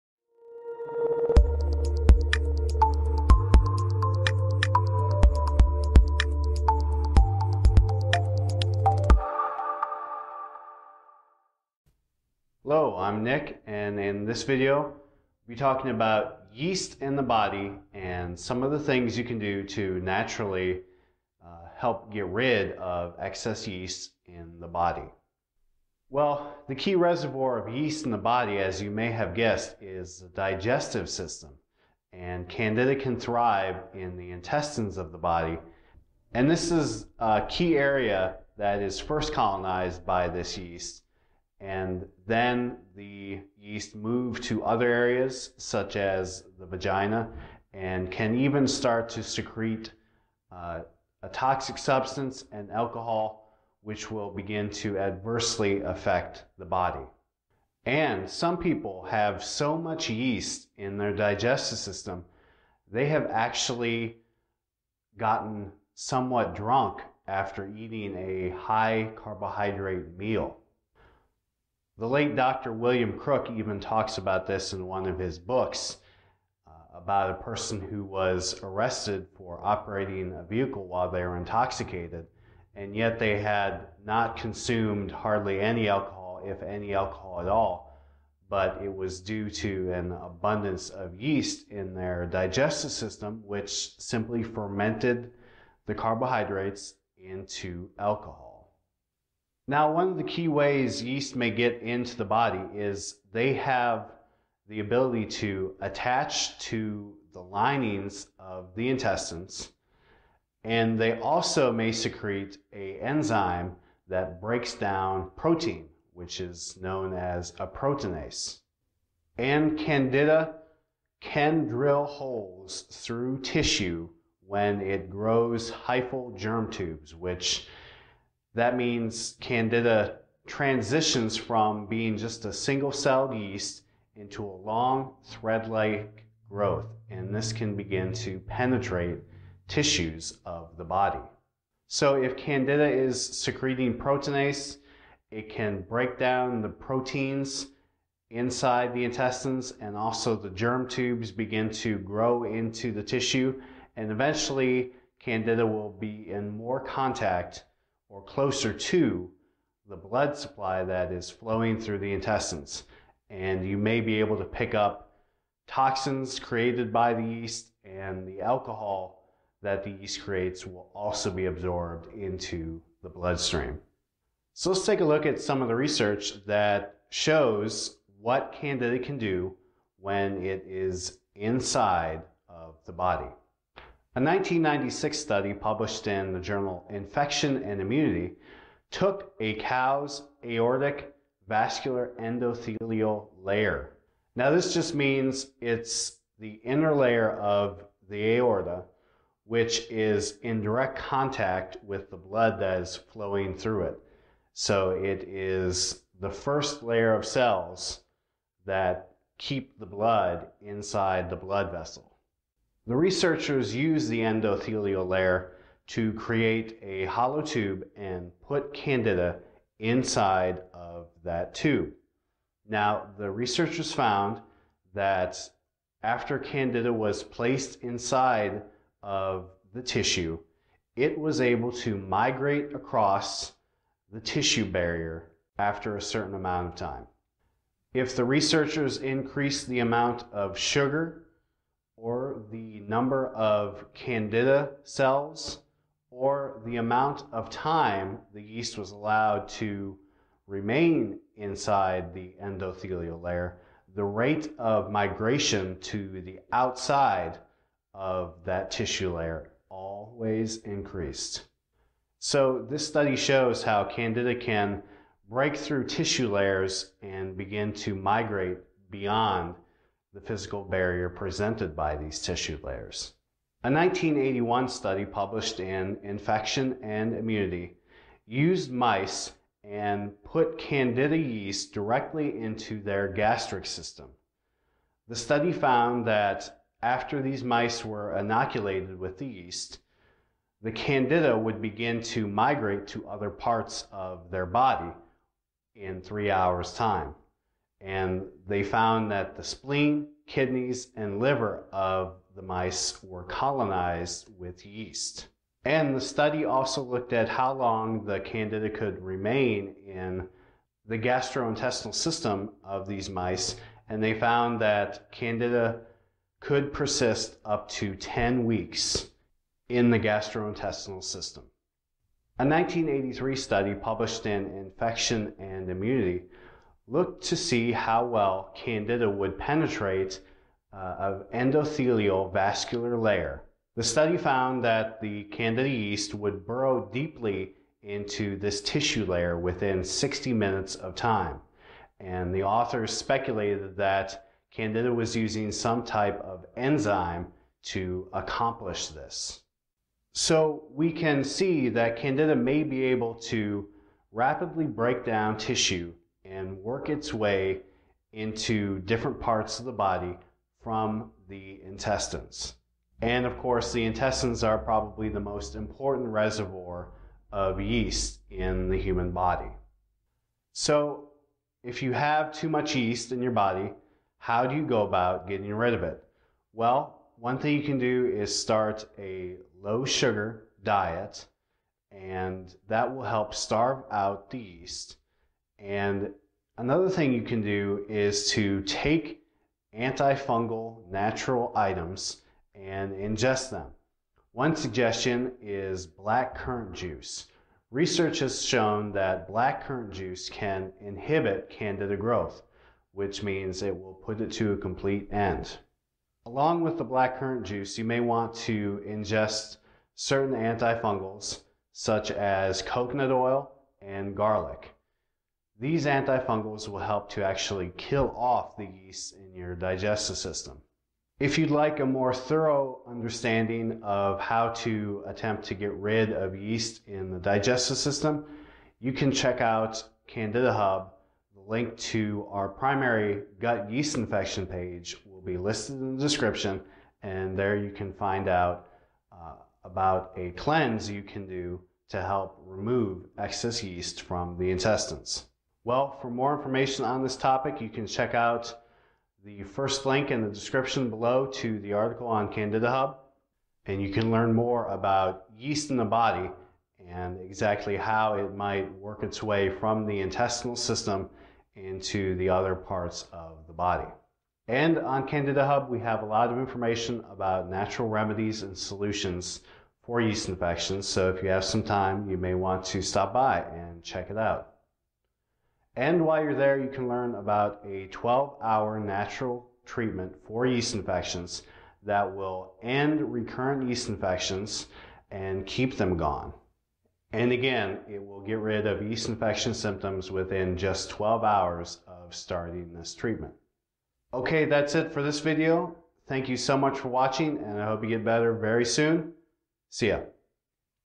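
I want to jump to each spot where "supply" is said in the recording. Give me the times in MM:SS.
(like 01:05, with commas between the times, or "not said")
02:40.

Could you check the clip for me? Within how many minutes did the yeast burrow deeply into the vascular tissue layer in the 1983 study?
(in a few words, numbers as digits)
60.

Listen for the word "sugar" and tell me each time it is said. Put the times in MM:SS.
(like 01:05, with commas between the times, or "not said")
04:00, 06:19.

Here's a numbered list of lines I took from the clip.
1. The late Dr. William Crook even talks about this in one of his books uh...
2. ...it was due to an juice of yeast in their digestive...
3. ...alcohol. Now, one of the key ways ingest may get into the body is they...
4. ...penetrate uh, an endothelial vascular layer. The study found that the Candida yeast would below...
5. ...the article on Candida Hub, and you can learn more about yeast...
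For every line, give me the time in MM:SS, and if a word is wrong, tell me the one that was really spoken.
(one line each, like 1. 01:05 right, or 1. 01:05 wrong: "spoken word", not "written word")
1. 01:12 right
2. 01:28 wrong: "abundance", not "juice"
3. 01:37 wrong: "yeast", not "ingest"
4. 05:29 wrong: "burrow", not "below"
5. 07:31 right.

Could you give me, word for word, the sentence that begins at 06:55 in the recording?
These antifungals will help to actually kill off the yeast in your digestive system.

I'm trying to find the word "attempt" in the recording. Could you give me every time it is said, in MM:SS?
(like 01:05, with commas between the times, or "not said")
07:05.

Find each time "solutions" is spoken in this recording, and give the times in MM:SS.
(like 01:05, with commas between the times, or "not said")
07:48.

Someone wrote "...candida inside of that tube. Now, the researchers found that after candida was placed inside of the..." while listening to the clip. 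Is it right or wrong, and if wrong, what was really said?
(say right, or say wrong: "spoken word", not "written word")
right.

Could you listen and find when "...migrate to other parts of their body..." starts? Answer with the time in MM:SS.
04:52.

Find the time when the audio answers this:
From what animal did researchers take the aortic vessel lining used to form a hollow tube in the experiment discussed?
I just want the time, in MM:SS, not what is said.
03:09.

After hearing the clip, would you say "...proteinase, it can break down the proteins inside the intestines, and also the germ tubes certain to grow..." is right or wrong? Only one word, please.
wrong.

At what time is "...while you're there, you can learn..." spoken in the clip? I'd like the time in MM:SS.
07:56.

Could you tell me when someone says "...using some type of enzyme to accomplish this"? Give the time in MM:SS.
05:45.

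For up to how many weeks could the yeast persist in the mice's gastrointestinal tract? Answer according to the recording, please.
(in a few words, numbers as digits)
10.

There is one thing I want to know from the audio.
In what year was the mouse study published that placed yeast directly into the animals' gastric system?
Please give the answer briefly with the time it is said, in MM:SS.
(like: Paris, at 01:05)
1981, at 04:33.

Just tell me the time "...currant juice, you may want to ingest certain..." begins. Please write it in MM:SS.
06:47.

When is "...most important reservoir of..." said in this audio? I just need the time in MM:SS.
06:05.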